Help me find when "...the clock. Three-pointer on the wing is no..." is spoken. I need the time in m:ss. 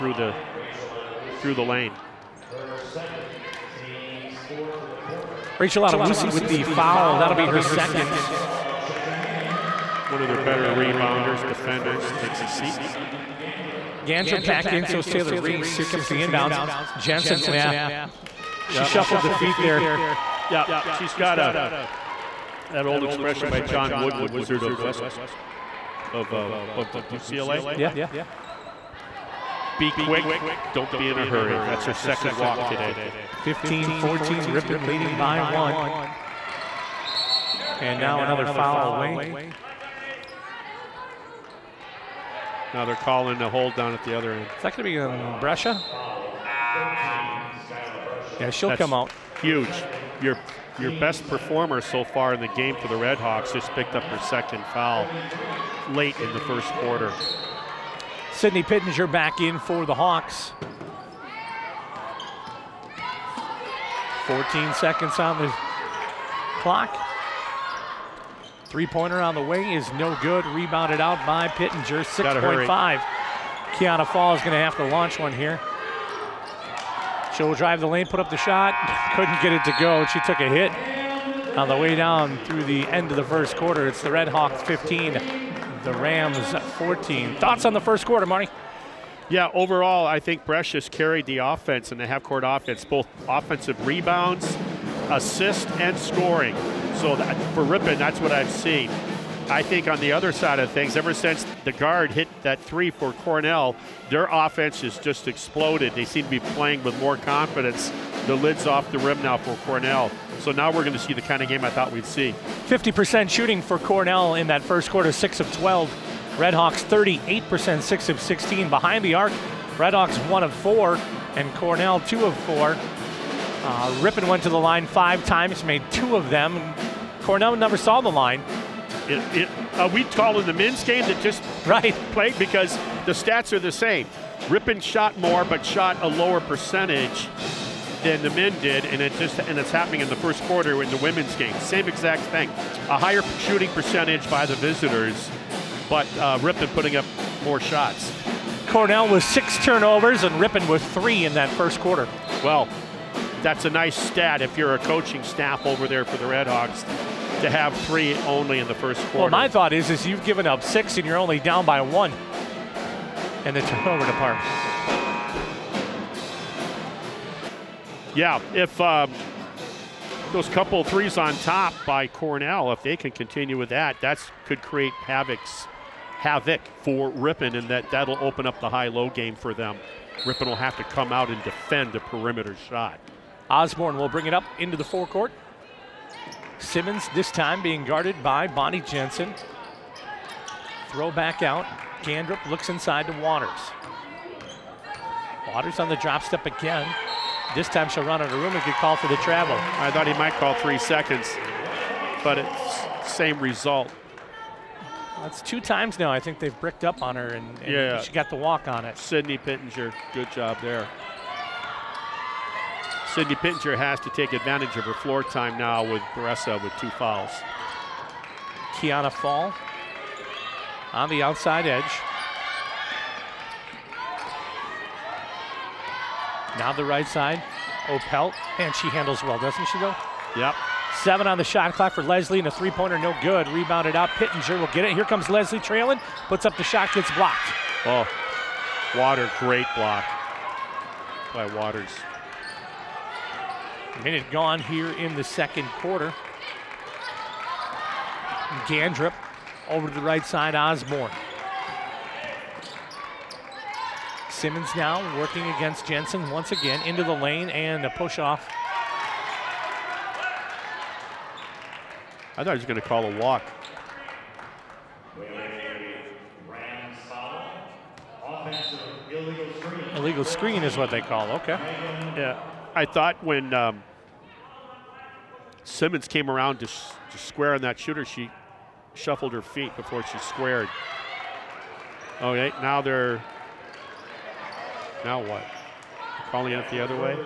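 1:05.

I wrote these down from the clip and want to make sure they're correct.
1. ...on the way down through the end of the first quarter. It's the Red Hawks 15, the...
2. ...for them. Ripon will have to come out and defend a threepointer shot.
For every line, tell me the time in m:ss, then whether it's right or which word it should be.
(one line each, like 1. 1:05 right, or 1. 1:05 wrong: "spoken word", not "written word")
1. 1:21 right
2. 2:59 wrong: "perimeter", not "threepointer".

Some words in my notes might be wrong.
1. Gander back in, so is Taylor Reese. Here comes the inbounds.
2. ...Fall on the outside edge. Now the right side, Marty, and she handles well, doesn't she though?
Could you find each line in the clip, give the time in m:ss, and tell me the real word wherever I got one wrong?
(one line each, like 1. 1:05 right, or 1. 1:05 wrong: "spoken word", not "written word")
1. 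0:14 right
2. 3:39 wrong: "Opelt", not "Marty".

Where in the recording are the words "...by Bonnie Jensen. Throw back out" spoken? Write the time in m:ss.
3:08.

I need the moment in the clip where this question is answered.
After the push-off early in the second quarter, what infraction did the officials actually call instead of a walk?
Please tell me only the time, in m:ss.
4:29.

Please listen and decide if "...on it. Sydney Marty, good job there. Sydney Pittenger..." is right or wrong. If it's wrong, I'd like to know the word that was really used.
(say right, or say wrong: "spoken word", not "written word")
wrong: "Pittenger", not "Marty".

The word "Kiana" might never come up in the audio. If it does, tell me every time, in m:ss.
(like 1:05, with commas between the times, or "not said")
1:13, 3:38.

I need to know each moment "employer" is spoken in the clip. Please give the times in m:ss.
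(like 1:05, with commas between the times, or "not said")
not said.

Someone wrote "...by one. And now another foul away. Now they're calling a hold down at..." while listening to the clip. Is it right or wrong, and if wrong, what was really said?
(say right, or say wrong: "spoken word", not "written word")
right.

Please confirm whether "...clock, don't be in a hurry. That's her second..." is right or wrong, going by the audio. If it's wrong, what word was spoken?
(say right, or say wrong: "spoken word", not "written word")
wrong: "quick", not "clock".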